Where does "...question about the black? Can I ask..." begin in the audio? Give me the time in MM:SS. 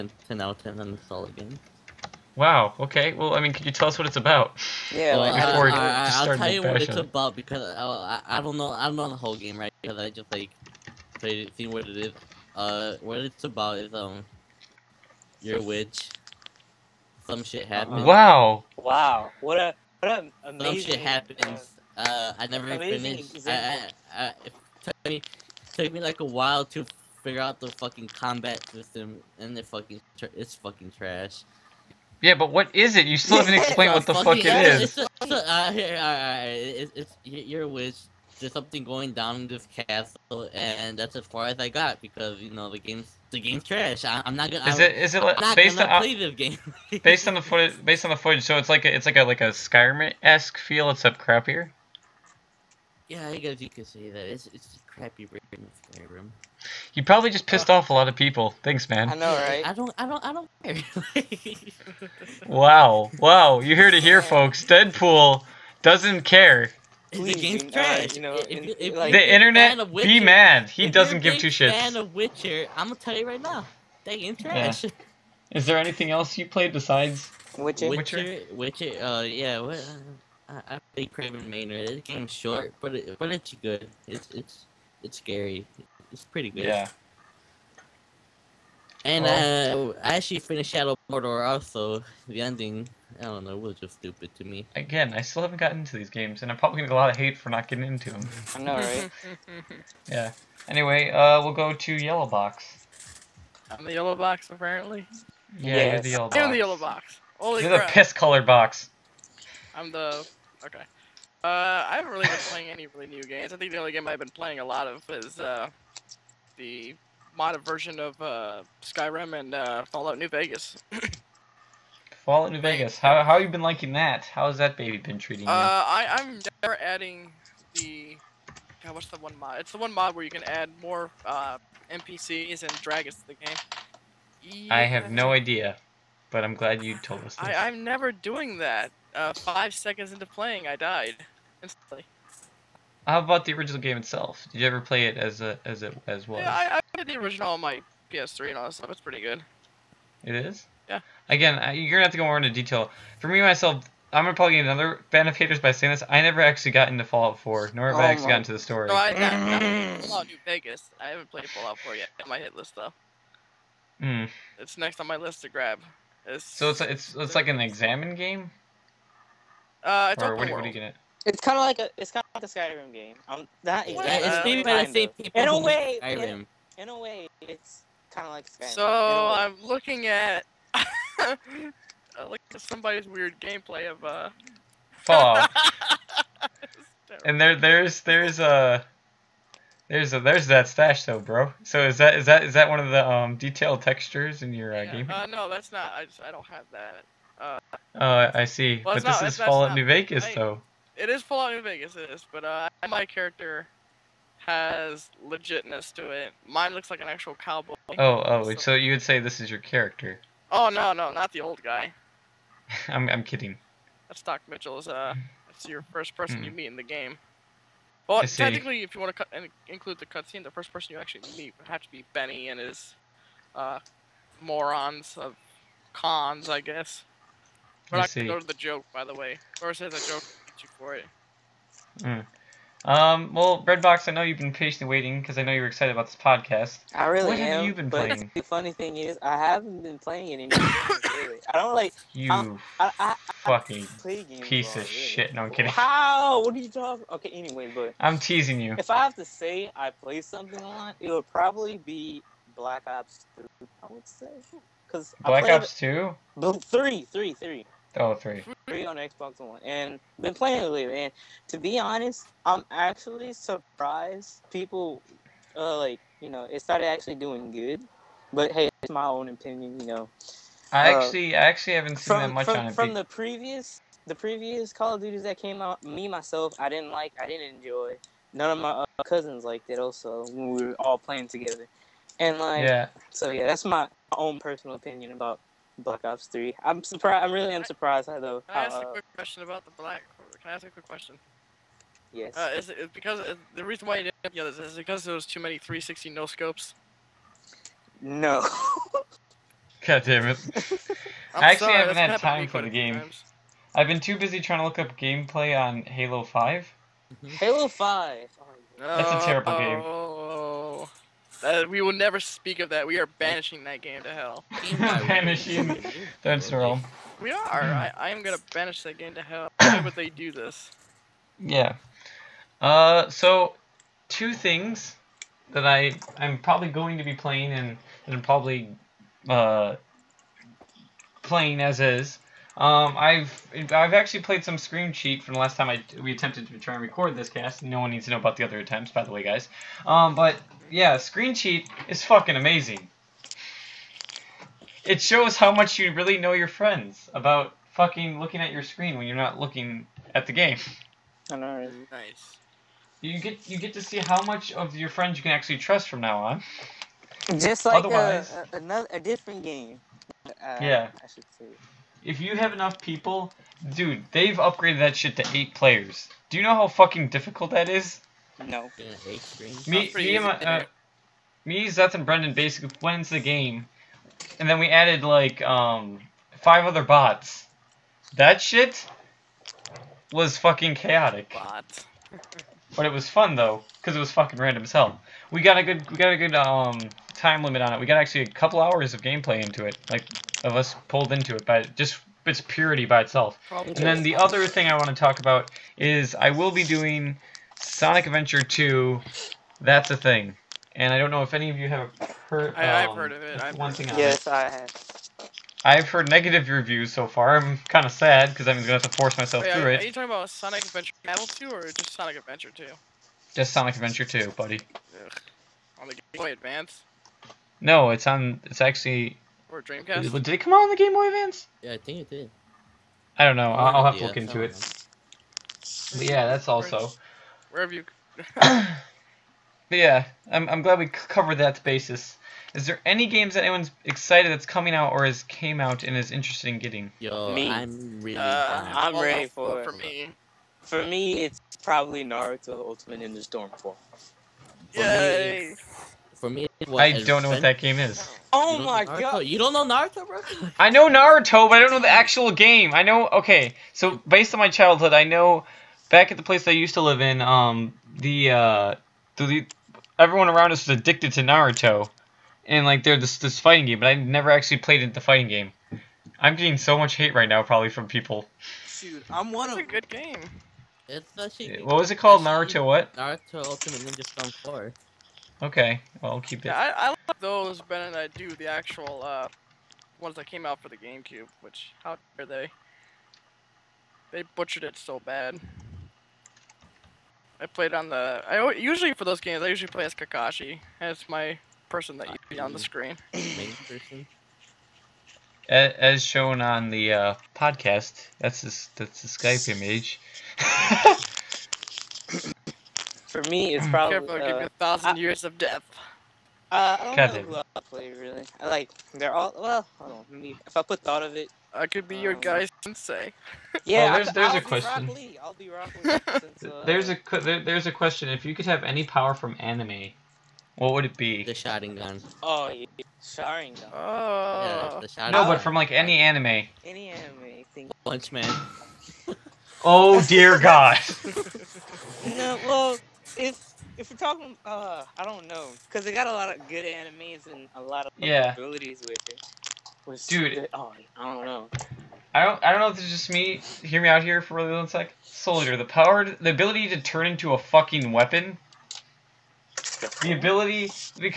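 04:49.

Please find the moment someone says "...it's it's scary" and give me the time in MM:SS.
01:24.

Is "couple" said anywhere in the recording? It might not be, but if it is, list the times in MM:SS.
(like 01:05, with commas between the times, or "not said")
06:28.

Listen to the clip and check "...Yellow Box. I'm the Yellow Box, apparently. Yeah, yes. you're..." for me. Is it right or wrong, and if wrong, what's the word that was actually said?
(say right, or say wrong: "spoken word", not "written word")
right.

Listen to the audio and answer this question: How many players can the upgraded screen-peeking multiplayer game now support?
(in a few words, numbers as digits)
8.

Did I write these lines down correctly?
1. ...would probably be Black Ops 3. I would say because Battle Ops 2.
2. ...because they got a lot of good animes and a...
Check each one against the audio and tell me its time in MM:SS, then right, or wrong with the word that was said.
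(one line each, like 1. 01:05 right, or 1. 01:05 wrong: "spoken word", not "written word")
1. 04:11 wrong: "Black", not "Battle"
2. 08:55 right.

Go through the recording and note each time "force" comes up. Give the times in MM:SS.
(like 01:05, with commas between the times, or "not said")
06:48.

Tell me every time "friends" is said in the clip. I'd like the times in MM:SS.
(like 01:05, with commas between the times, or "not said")
05:46, 05:54.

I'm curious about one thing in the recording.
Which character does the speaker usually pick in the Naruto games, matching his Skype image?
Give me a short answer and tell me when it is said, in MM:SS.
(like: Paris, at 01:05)
Kakashi, at 08:09.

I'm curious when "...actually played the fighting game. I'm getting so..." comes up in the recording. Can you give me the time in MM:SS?
07:44.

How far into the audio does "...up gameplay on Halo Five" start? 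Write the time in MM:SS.
05:04.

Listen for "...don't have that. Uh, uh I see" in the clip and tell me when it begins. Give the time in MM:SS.
03:16.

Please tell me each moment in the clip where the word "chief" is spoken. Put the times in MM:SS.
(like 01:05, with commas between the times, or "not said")
not said.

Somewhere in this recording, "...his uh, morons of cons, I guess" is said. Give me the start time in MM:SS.
03:42.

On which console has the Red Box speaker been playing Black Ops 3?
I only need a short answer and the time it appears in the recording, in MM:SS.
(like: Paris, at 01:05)
Xbox One, at 04:18.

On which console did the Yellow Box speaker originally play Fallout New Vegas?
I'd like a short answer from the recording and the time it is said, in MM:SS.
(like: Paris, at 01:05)
PS3, at 02:28.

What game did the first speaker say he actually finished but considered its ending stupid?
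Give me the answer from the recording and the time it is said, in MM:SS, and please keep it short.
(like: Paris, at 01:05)
Shadow Mordor, at 01:30.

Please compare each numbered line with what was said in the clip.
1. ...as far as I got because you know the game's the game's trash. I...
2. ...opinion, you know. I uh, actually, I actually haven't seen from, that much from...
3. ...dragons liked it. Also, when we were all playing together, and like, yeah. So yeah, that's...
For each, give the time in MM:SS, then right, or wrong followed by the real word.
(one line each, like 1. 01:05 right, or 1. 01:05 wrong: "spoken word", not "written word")
1. 00:41 right
2. 04:29 right
3. 04:39 wrong: "cousins", not "dragons".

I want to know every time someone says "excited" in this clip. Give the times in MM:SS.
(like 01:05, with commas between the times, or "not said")
03:55, 07:13.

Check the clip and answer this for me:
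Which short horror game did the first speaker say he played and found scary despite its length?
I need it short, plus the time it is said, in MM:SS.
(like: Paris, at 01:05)
Craven Manor, at 01:21.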